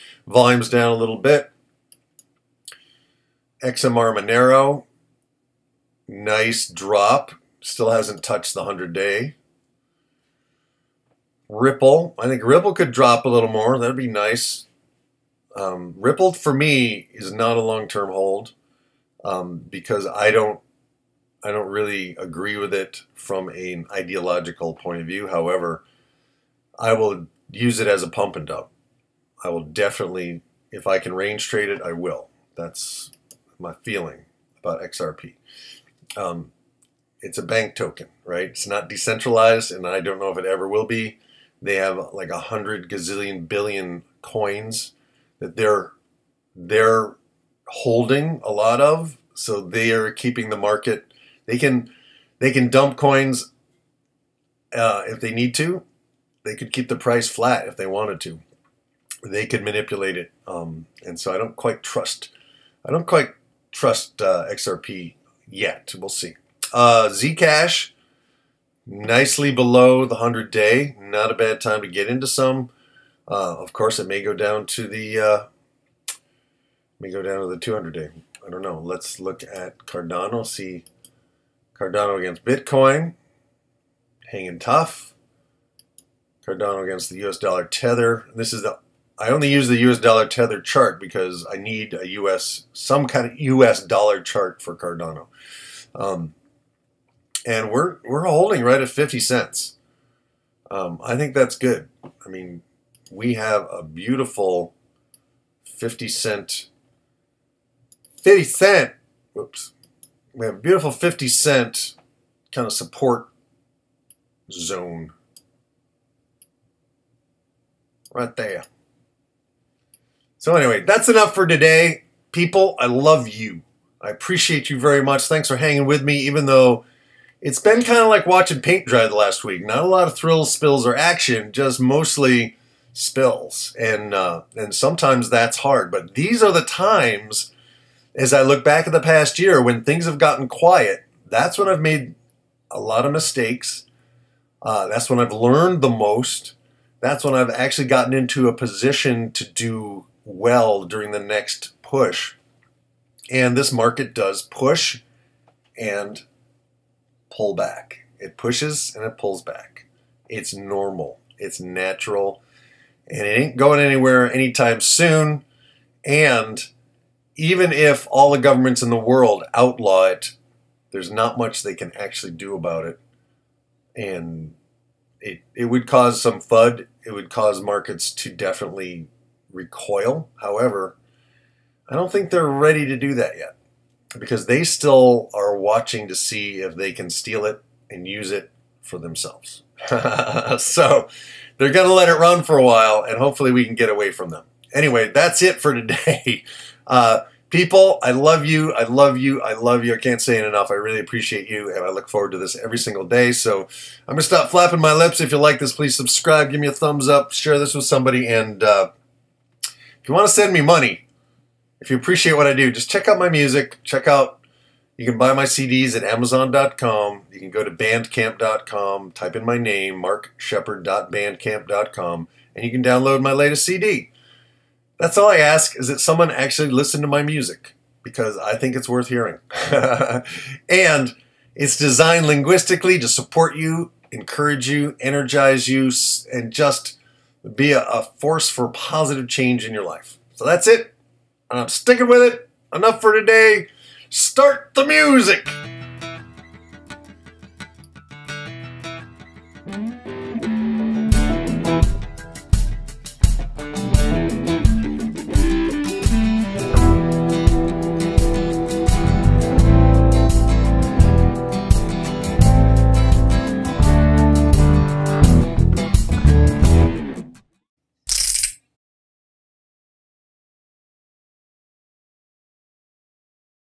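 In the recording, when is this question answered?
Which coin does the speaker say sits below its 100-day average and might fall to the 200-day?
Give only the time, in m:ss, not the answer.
1:07.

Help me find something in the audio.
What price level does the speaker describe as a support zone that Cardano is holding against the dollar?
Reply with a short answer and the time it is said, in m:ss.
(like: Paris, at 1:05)
50 cents, at 1:38.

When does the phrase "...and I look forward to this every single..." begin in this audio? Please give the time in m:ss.
3:21.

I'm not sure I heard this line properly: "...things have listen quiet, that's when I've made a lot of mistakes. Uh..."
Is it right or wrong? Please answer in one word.
wrong.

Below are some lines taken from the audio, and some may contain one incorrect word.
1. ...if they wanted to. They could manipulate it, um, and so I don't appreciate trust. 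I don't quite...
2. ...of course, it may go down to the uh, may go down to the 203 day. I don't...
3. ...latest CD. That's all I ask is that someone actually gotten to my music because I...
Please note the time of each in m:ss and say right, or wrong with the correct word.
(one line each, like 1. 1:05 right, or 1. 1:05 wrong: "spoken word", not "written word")
1. 0:57 wrong: "quite", not "appreciate"
2. 1:13 wrong: "200", not "203"
3. 3:43 wrong: "listen", not "gotten".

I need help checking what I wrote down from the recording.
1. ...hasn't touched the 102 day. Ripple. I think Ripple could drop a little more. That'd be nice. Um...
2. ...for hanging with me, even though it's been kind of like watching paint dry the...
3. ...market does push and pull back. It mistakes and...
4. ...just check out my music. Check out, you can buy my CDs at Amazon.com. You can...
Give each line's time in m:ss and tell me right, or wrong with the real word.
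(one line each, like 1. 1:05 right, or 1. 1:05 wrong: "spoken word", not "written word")
1. 0:07 wrong: "100", not "102"
2. 2:05 right
3. 2:33 wrong: "pushes", not "mistakes"
4. 3:32 right.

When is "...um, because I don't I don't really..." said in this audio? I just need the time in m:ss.
0:19.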